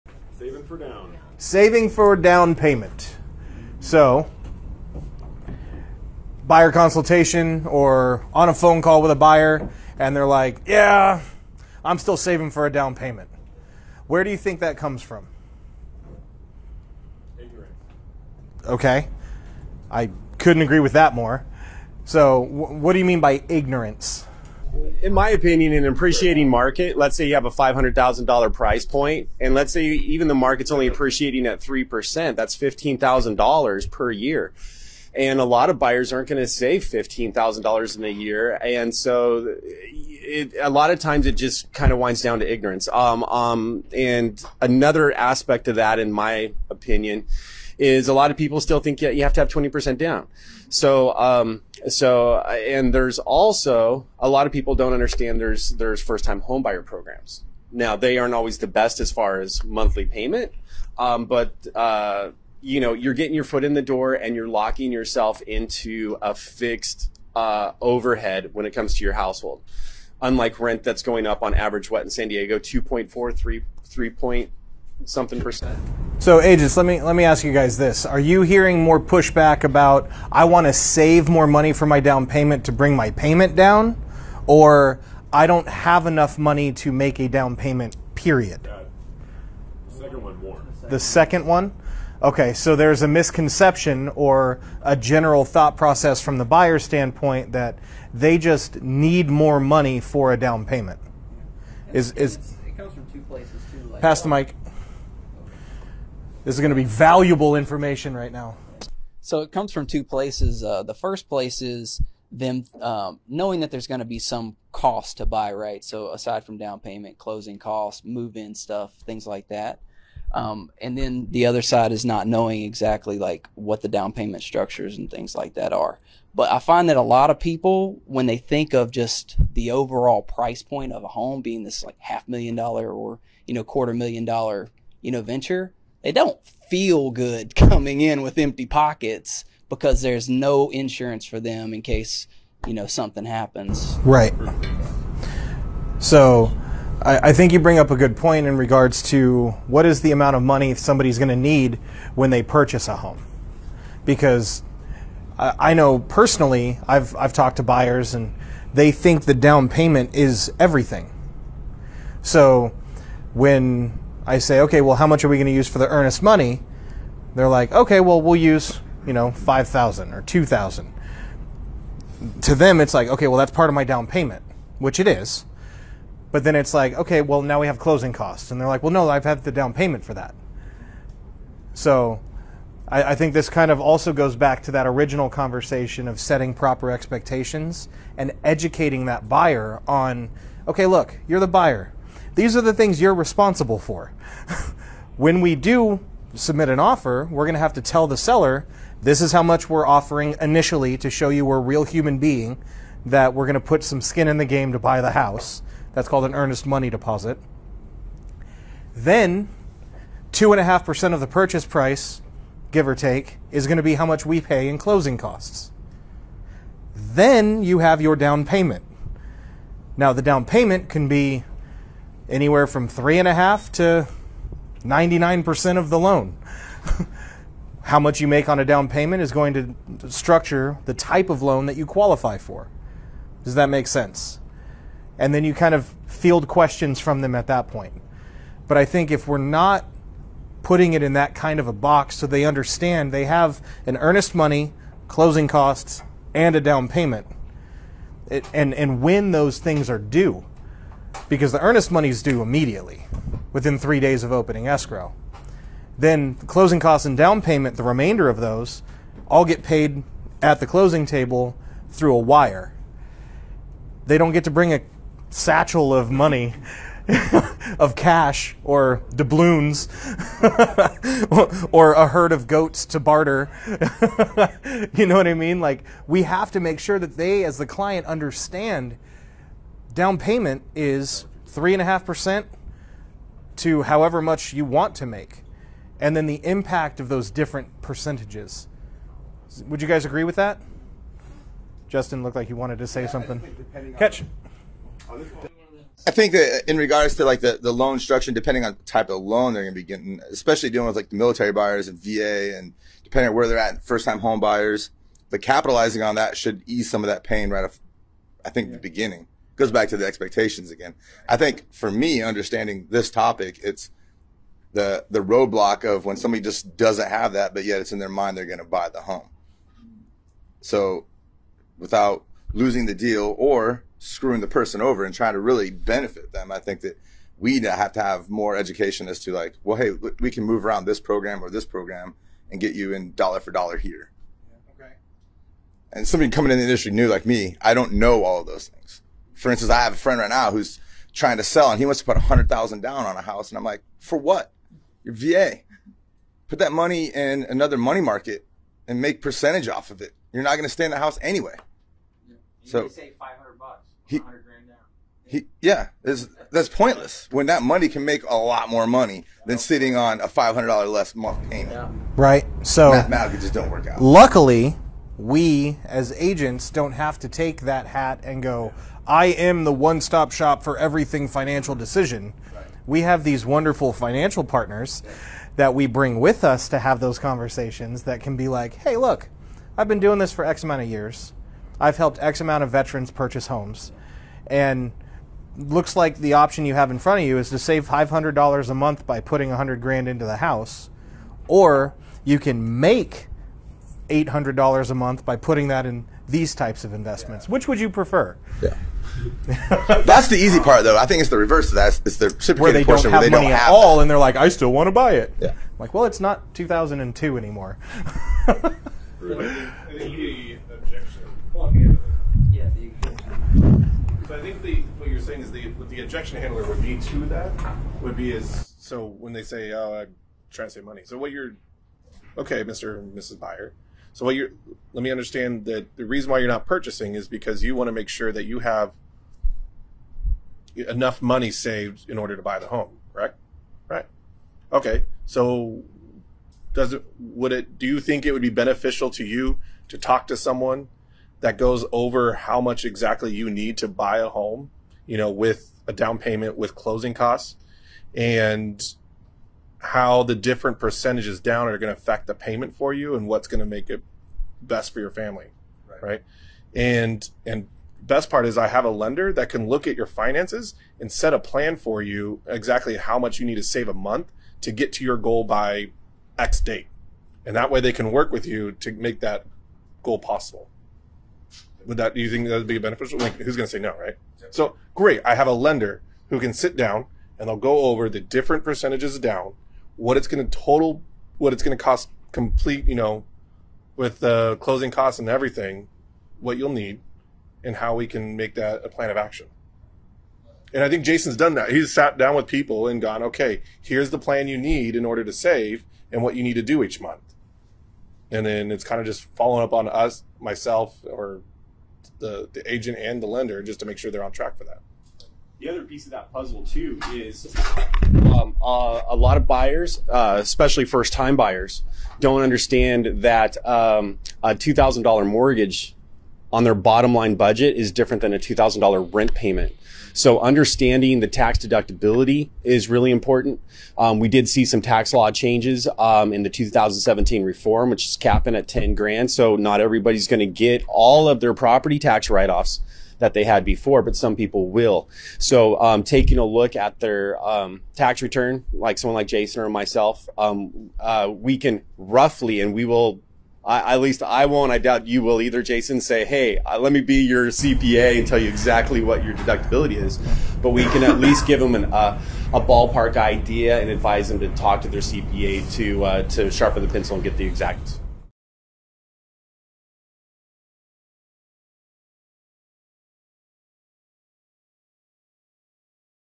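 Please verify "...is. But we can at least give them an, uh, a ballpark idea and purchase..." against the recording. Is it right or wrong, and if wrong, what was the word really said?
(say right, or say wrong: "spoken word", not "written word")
wrong: "advise", not "purchase".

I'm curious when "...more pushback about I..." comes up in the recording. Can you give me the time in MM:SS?
01:18.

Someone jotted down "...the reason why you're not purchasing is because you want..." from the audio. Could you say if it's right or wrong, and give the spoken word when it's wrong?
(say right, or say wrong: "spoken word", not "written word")
right.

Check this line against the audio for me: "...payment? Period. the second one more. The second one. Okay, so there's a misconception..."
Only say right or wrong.
right.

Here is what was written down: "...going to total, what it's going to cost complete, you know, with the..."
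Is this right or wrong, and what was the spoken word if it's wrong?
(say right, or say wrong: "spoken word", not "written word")
right.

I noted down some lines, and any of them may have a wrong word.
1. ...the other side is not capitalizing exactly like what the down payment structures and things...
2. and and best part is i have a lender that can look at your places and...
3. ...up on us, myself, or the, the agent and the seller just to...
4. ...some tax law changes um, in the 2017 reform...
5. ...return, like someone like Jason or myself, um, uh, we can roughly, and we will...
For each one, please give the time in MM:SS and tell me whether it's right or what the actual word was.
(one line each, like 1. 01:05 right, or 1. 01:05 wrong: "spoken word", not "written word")
1. 02:01 wrong: "knowing", not "capitalizing"
2. 07:36 wrong: "finances", not "places"
3. 08:19 wrong: "lender", not "seller"
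4. 08:44 right
5. 08:58 right.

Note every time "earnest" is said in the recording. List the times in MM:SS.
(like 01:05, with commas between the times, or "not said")
02:45, 03:26, 04:03, 04:11.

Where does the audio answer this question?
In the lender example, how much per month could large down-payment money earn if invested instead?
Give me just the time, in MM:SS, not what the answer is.
06:34.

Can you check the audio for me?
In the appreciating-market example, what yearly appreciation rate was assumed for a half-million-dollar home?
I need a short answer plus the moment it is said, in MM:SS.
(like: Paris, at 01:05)
3%, at 00:31.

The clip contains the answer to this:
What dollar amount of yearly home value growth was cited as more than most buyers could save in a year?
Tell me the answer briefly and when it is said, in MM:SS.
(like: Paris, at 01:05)
$15,000, at 00:32.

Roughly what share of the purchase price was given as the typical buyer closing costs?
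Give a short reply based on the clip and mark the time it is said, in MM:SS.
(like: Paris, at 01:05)
2.5%, at 03:30.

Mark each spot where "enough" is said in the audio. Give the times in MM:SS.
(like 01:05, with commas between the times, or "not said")
01:26, 07:10.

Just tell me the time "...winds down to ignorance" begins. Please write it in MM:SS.
00:41.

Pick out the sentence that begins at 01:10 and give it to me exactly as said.
Unlike rent that's going up on average, what in San Diego, two point four three three point something percent.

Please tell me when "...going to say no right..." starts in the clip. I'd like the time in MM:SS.
07:53.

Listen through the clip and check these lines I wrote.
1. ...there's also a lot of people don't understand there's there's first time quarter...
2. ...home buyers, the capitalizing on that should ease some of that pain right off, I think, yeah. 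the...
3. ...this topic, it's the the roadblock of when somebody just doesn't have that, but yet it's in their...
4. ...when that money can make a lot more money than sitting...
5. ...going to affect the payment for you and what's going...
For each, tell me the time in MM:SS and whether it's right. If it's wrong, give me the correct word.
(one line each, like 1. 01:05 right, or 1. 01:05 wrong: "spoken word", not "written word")
1. 00:52 wrong: "homebuyer", not "quarter"
2. 05:04 right
3. 05:12 right
4. 05:57 right
5. 07:31 right.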